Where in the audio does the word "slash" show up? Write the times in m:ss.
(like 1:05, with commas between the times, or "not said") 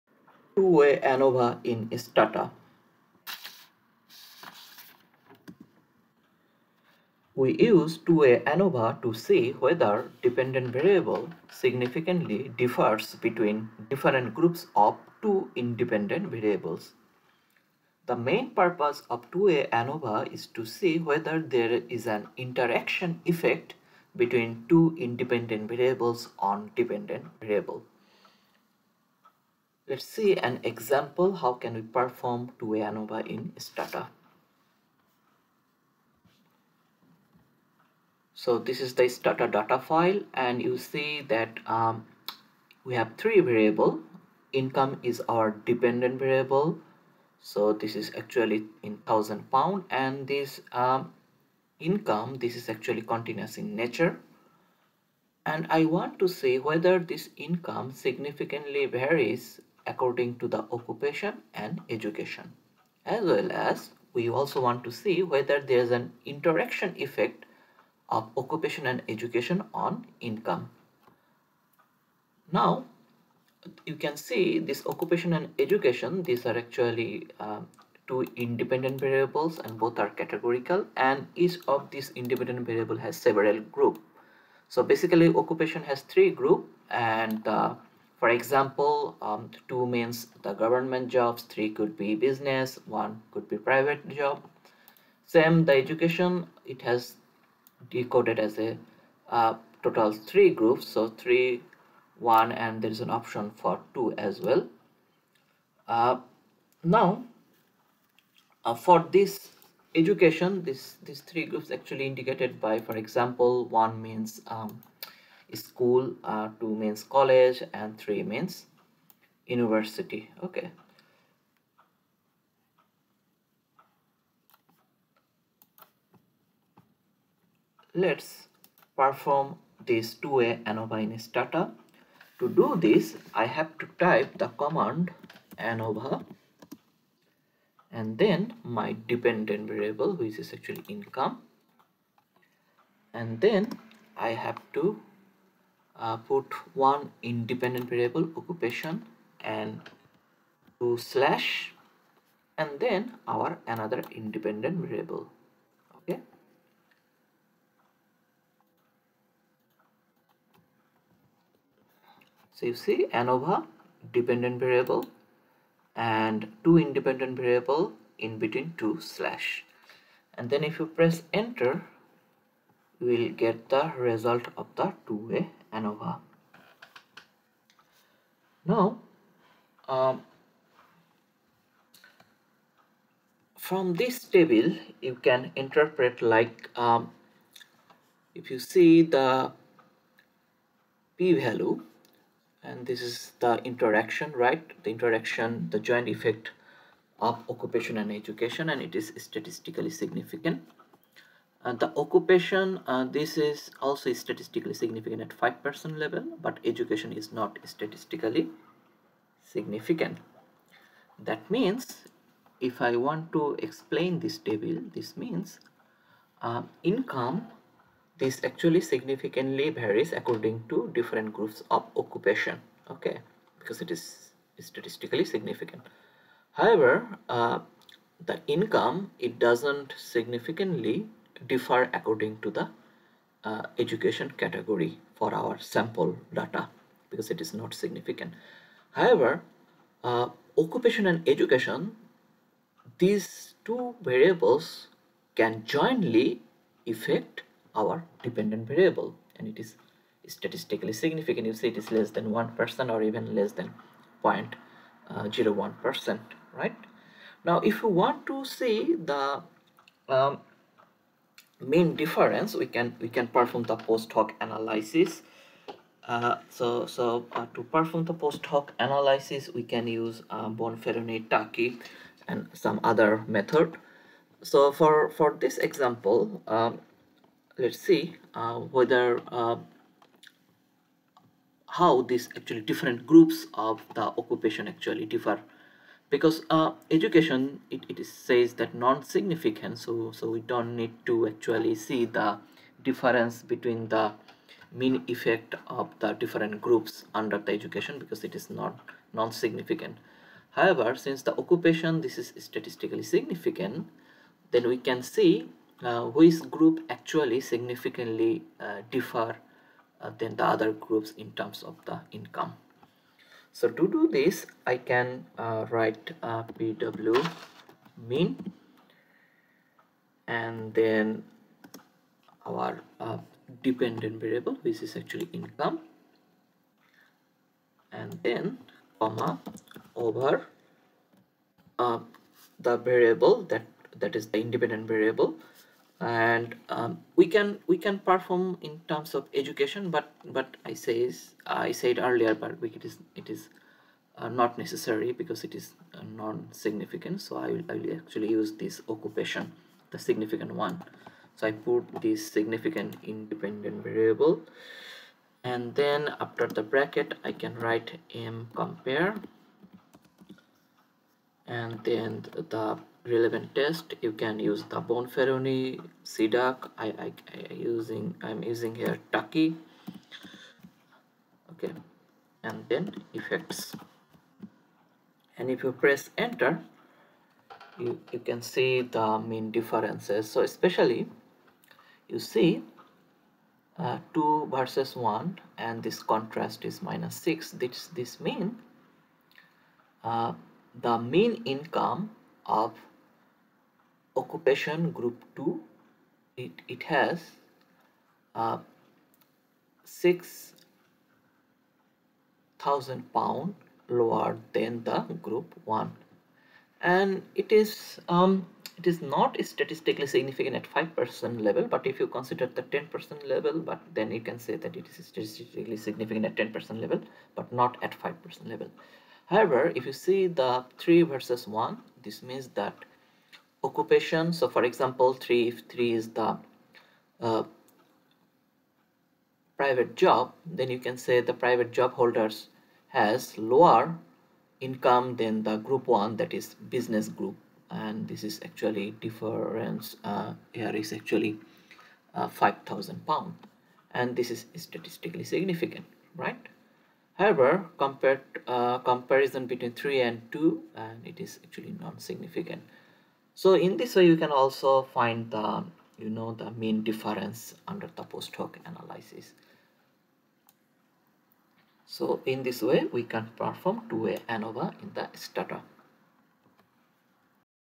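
2:30, 2:48.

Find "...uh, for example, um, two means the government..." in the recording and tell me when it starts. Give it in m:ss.
1:27.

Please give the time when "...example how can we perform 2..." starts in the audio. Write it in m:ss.
0:30.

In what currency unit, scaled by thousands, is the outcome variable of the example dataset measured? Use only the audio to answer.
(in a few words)
thousand pound.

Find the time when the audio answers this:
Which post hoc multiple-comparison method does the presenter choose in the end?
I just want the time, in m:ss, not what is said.
6:09.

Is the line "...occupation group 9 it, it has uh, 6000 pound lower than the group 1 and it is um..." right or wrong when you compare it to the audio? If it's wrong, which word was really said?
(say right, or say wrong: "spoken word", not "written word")
wrong: "2", not "9".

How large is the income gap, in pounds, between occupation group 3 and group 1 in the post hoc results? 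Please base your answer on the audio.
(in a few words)
5000 pound.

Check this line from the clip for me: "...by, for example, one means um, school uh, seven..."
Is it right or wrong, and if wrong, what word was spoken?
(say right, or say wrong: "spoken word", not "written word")
wrong: "two", not "seven".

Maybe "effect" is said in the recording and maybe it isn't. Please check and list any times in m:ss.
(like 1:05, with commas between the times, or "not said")
0:23, 1:06, 3:16, 4:55, 6:13.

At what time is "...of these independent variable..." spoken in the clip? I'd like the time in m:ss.
1:21.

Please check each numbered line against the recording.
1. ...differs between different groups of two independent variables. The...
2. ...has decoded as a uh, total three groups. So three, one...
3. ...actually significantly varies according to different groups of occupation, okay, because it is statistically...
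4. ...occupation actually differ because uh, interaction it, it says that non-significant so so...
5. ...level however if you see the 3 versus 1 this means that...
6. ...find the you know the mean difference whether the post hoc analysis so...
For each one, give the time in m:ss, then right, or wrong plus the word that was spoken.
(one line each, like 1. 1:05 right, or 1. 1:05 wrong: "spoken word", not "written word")
1. 0:12 right
2. 1:36 right
3. 3:38 right
4. 4:44 wrong: "education", not "interaction"
5. 6:58 right
6. 7:34 wrong: "under", not "whether".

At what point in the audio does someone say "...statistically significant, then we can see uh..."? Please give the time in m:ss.
5:02.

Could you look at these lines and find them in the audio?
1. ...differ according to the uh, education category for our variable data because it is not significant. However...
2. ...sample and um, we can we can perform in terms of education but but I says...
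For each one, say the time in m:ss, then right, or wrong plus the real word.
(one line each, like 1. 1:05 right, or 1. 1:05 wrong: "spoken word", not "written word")
1. 3:51 wrong: "sample", not "variable"
2. 5:34 wrong: "variable", not "sample".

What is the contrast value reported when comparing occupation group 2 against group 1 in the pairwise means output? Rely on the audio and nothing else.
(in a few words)
-6.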